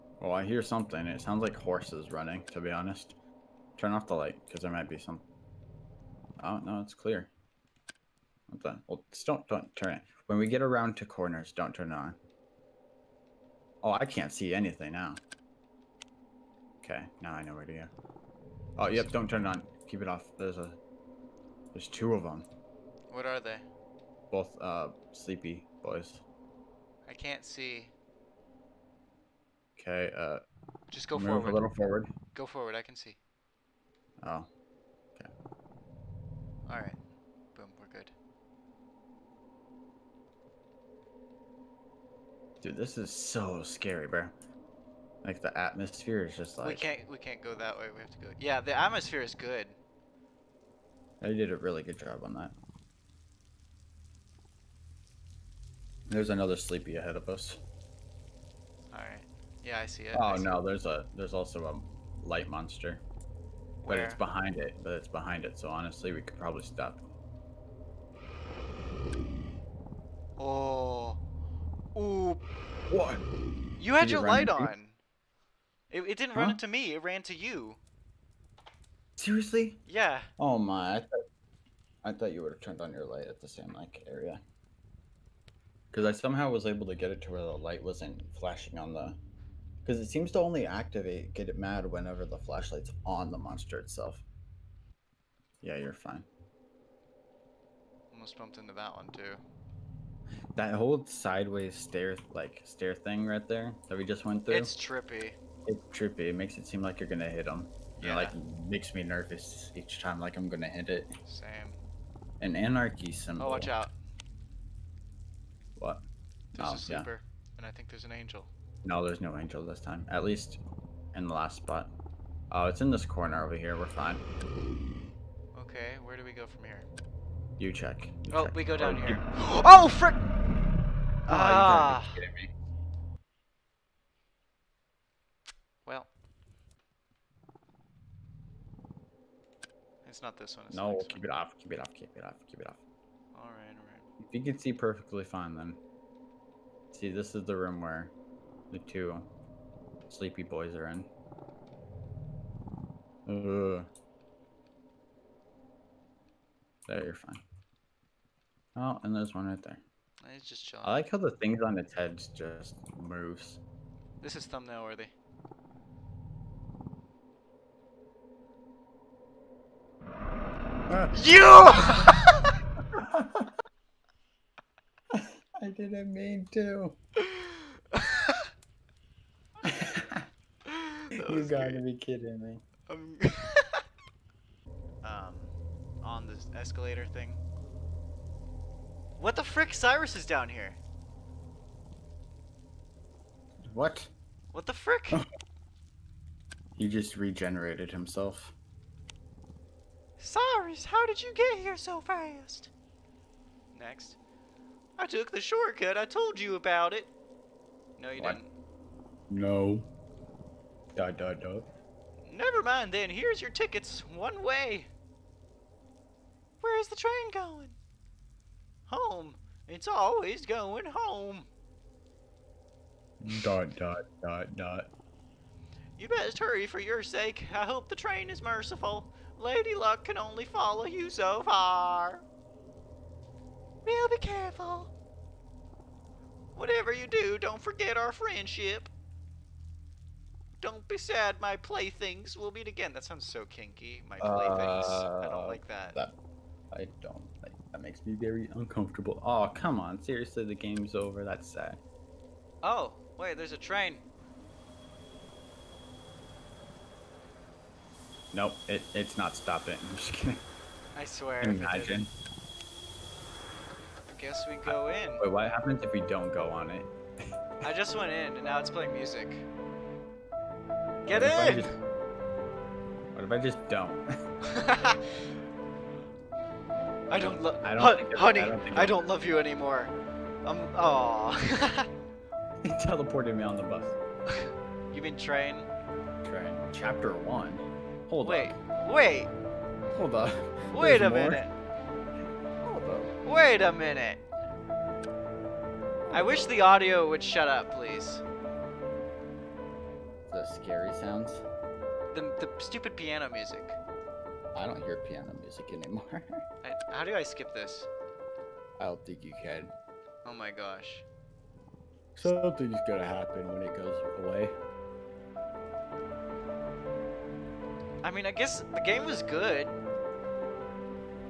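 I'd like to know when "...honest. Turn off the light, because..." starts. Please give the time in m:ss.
0:02.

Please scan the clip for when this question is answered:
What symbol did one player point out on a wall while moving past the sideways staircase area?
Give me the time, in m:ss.
1:52.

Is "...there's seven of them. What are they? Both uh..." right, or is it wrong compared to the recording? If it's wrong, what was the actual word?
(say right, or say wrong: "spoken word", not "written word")
wrong: "two", not "seven".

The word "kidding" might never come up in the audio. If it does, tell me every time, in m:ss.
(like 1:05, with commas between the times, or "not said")
3:01, 4:20.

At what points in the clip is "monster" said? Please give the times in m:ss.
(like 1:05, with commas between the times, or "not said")
1:02, 1:33.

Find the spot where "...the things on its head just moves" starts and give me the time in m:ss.
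2:41.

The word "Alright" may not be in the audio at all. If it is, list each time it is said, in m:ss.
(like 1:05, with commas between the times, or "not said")
0:36, 0:58.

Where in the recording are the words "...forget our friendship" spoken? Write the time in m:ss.
3:57.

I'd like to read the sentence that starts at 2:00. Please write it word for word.
At least in the last spot.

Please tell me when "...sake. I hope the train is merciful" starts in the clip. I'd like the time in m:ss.
3:47.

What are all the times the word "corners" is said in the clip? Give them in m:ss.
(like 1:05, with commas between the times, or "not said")
0:11, 2:03.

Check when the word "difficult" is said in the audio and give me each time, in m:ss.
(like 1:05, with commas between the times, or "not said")
not said.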